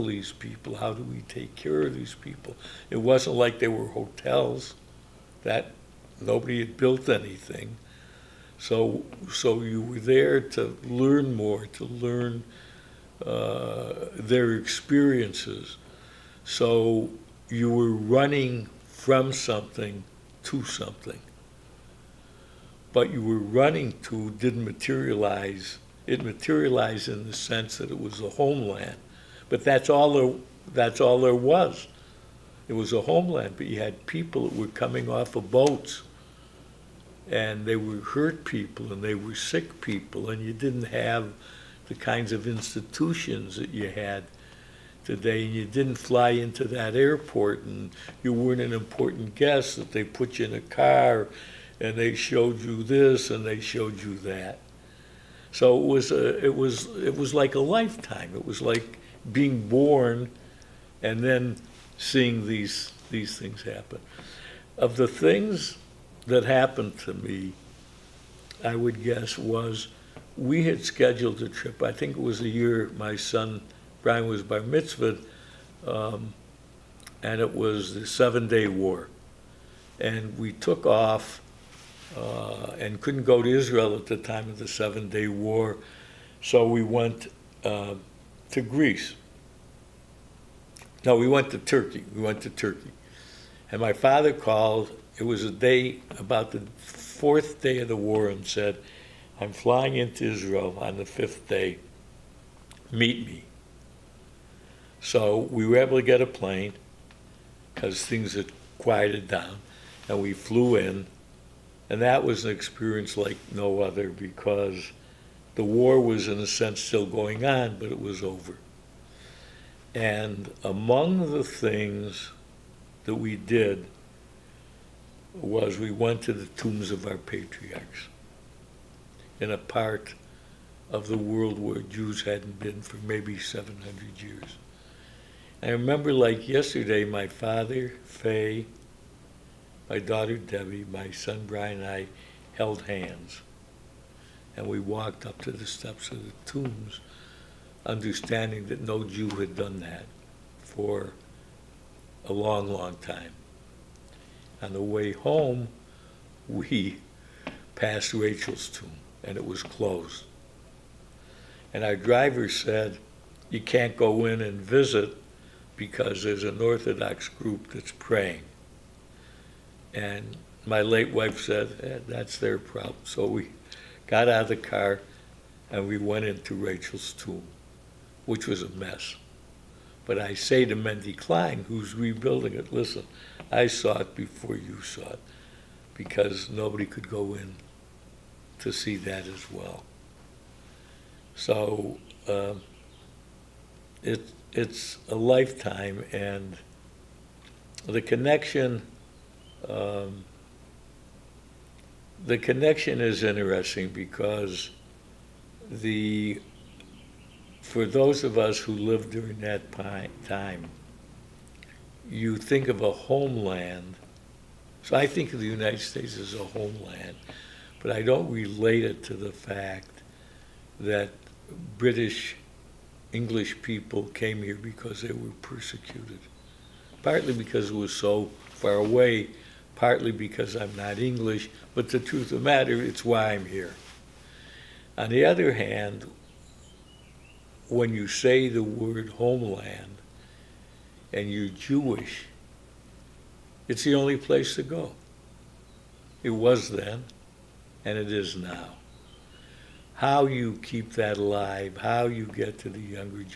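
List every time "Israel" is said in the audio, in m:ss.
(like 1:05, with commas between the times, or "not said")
1:23, 1:40.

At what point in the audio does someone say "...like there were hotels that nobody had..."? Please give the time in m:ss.
0:03.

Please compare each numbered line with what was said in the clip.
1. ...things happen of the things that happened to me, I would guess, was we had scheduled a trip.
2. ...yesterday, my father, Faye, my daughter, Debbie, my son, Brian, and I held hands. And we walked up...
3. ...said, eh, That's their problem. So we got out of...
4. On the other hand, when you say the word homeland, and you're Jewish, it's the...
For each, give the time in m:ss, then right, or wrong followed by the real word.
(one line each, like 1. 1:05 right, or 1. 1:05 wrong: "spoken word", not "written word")
1. 1:03 right
2. 2:16 right
3. 2:51 right
4. 3:54 right.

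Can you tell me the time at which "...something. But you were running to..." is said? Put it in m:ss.
0:20.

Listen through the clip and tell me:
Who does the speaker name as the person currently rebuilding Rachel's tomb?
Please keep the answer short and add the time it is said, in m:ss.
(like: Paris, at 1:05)
Mendy Klein, at 3:00.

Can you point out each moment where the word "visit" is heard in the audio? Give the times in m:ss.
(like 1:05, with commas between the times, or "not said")
2:44.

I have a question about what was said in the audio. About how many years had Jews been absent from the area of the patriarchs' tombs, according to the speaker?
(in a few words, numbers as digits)
700.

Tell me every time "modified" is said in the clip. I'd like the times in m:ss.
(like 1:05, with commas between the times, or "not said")
not said.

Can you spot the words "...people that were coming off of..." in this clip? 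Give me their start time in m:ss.
0:34.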